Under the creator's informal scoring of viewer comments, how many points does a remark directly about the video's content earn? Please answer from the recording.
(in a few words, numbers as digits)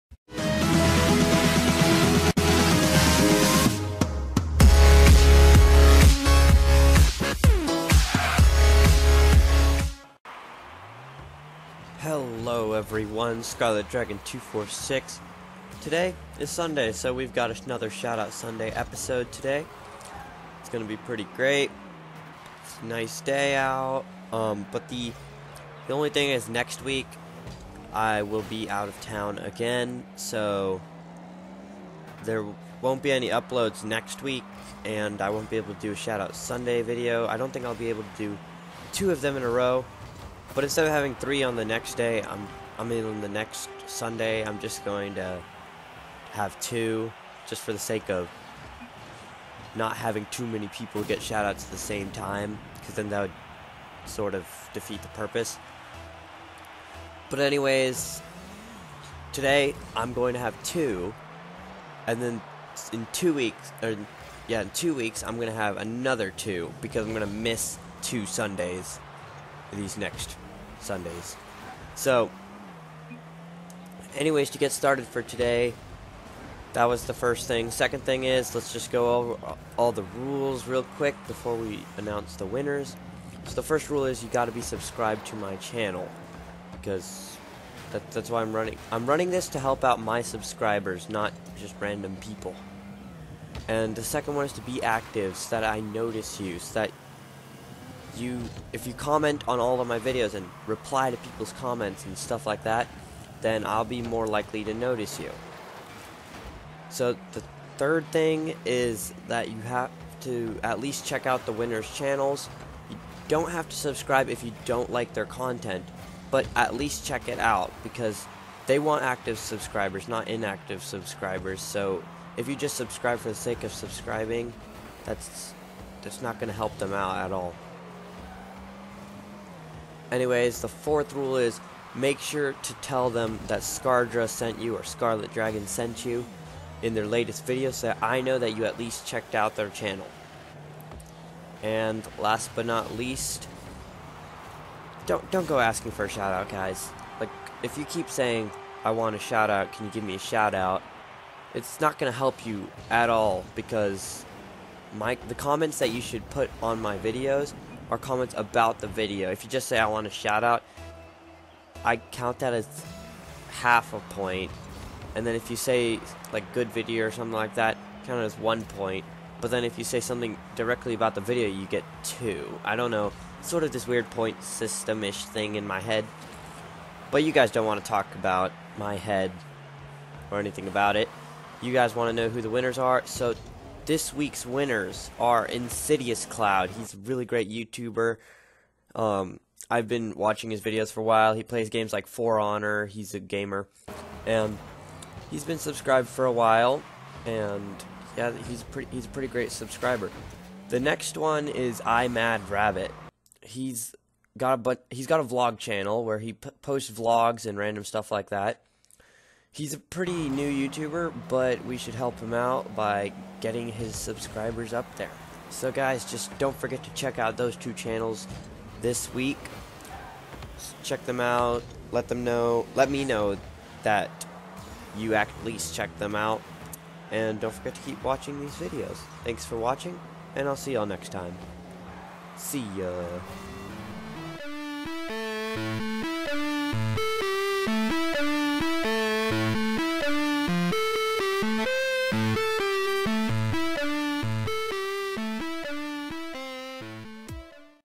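2.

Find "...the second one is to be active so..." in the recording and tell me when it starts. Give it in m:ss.
1:33.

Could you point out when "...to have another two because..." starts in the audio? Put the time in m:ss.
1:05.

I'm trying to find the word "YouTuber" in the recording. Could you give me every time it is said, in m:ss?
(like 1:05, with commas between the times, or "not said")
3:07, 3:30.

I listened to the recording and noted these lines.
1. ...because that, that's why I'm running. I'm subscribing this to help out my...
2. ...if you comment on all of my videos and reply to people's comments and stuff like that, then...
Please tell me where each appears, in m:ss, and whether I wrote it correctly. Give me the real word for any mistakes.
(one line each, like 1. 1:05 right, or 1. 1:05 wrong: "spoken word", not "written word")
1. 1:26 wrong: "running", not "subscribing"
2. 1:38 right.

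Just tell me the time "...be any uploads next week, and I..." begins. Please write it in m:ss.
0:33.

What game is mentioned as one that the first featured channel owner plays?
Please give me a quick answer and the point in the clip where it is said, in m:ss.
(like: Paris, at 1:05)
For Honor, at 3:12.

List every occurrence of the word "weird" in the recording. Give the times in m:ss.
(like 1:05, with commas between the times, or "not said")
2:53.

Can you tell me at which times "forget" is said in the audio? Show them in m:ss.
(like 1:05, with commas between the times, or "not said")
3:36, 3:47.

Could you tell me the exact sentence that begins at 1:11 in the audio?
So, anyways, to get started for today, that was the first thing.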